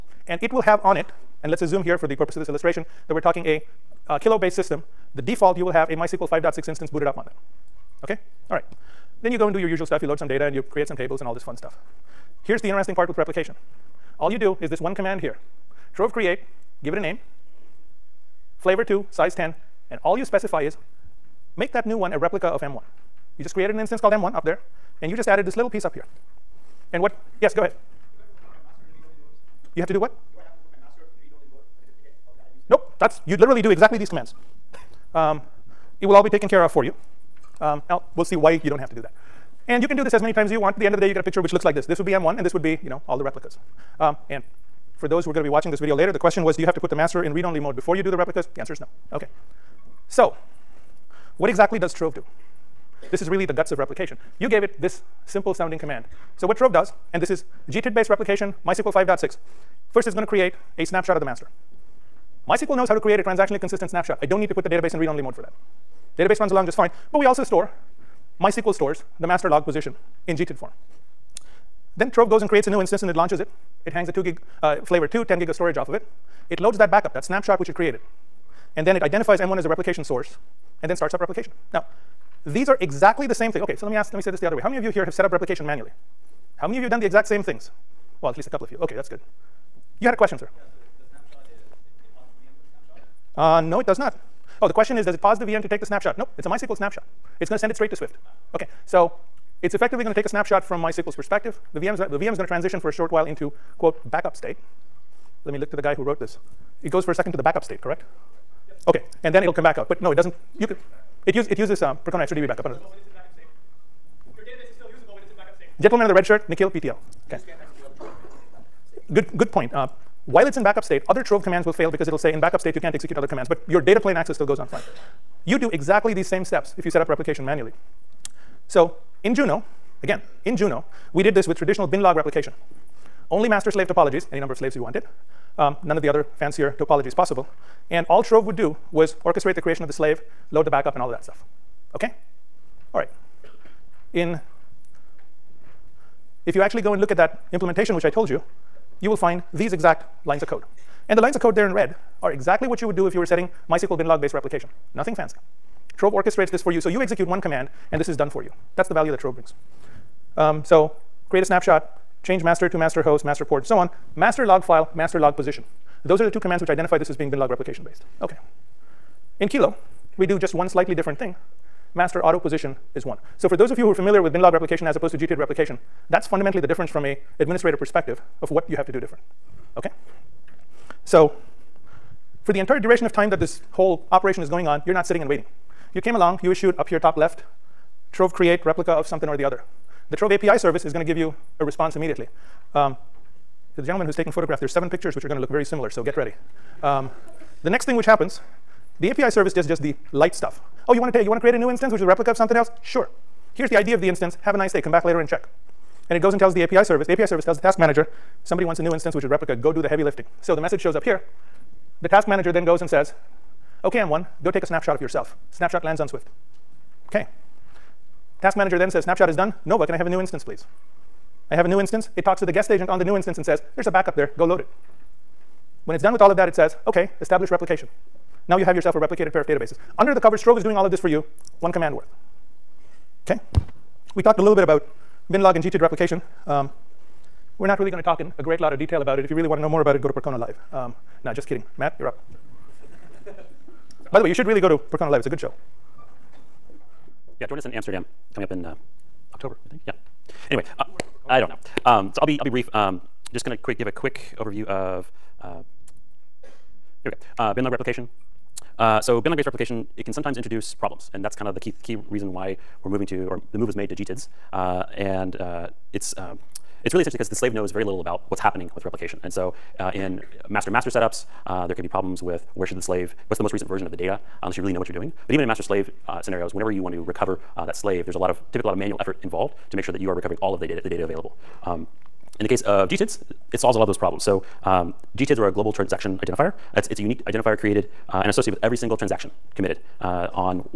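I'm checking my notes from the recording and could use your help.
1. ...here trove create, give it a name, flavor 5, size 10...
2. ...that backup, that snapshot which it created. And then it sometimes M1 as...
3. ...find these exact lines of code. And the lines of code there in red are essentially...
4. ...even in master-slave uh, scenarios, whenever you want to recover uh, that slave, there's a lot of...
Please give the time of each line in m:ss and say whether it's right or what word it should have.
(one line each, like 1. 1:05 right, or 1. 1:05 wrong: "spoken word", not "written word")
1. 0:15 wrong: "2", not "5"
2. 1:16 wrong: "identifies", not "sometimes"
3. 2:29 wrong: "exactly", not "essentially"
4. 4:35 right.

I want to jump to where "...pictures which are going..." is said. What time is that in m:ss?
3:14.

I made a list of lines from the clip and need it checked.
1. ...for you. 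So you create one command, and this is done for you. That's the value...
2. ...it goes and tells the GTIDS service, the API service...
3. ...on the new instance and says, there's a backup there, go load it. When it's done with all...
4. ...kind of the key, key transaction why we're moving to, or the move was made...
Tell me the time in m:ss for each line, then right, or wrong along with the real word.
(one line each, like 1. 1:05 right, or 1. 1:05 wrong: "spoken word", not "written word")
1. 2:36 wrong: "execute", not "create"
2. 3:26 wrong: "API", not "GTIDS"
3. 3:42 right
4. 4:21 wrong: "reason", not "transaction".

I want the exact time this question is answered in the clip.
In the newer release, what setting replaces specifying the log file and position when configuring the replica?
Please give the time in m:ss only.
2:51.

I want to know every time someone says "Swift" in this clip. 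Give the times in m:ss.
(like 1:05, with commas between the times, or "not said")
1:37, 3:36.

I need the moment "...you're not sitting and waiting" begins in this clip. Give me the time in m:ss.
3:04.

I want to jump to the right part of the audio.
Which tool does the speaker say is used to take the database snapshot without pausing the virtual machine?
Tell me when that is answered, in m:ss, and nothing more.
1:52.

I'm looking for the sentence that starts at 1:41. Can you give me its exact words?
The, the VM is going to transition for a short while into, quote, backup state.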